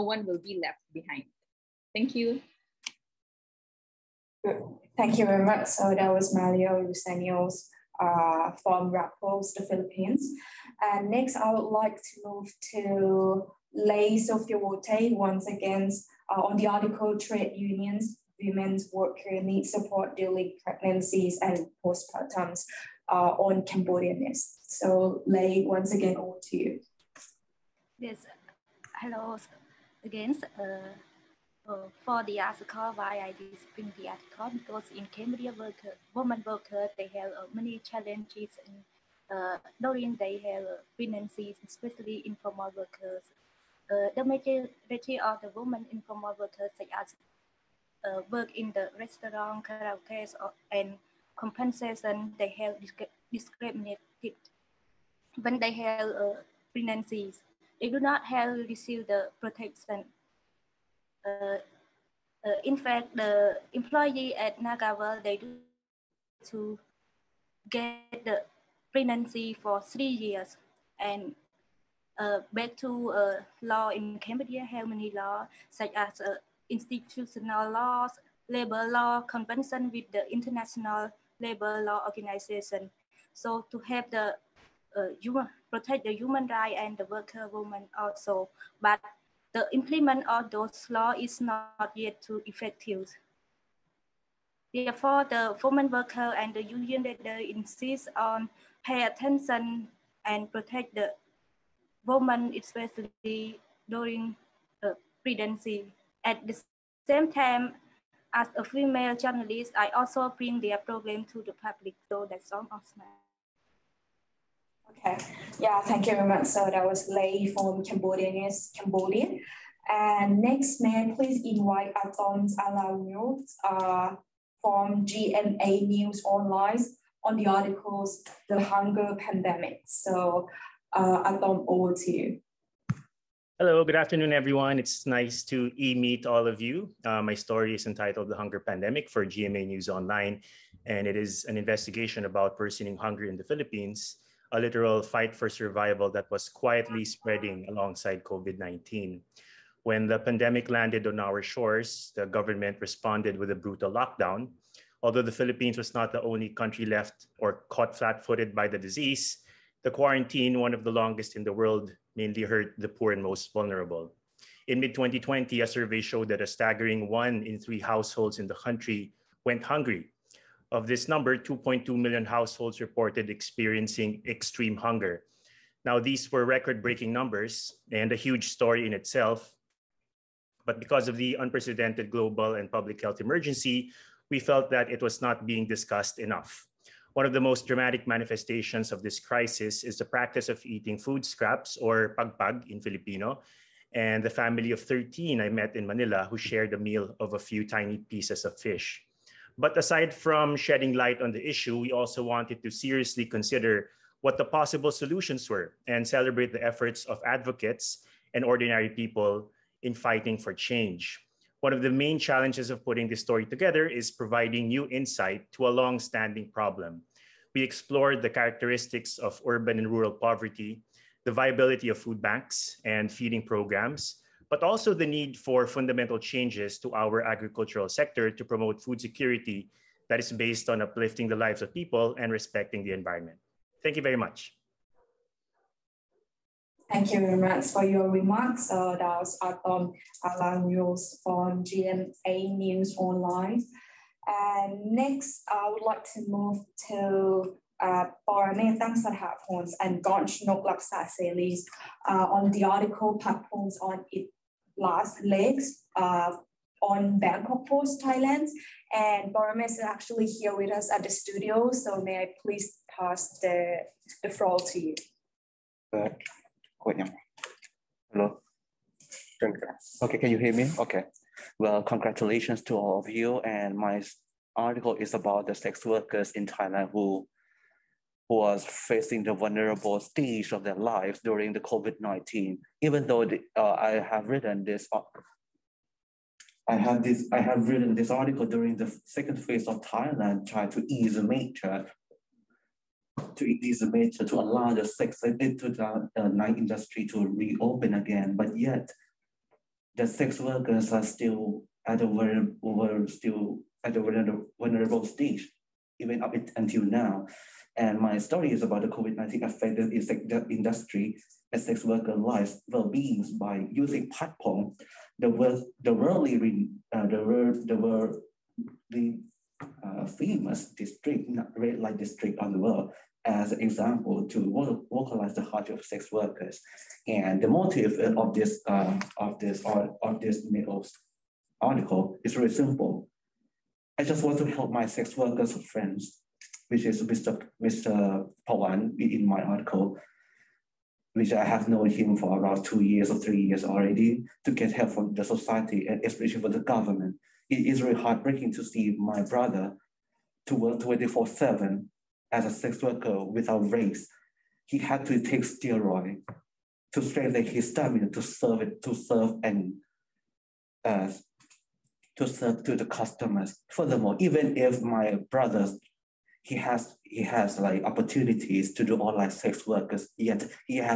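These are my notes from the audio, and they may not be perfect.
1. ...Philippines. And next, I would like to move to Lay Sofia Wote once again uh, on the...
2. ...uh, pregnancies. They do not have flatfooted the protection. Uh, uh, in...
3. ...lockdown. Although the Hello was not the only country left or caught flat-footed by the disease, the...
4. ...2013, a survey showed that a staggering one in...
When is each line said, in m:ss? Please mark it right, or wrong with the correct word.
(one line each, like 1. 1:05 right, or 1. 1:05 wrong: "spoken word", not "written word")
1. 0:09 right
2. 0:56 wrong: "received", not "flatfooted"
3. 2:33 wrong: "Philippines", not "Hello"
4. 2:44 wrong: "2020", not "2013".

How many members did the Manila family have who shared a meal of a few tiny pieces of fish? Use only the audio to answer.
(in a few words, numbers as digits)
13.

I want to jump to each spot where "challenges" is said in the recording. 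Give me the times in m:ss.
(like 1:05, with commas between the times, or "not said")
0:37, 3:32.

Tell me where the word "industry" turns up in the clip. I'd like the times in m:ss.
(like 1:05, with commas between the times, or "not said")
4:56, 5:10.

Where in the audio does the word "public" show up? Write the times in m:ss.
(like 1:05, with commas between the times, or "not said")
1:51, 3:02.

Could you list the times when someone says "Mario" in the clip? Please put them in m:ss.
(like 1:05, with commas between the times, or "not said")
0:06.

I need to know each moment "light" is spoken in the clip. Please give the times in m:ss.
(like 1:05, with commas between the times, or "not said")
3:20, 5:21.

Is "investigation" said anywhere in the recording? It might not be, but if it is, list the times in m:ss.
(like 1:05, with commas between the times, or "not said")
2:21.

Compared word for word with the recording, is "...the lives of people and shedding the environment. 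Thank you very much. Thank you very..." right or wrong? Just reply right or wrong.
wrong.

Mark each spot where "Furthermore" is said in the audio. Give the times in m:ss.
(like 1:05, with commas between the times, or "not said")
6:03.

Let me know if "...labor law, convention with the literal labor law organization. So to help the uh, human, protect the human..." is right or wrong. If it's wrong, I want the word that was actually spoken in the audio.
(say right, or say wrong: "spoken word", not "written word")
wrong: "international", not "literal".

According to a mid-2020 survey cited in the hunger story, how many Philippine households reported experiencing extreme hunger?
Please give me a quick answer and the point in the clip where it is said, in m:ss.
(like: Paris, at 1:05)
2.2 million, at 2:51.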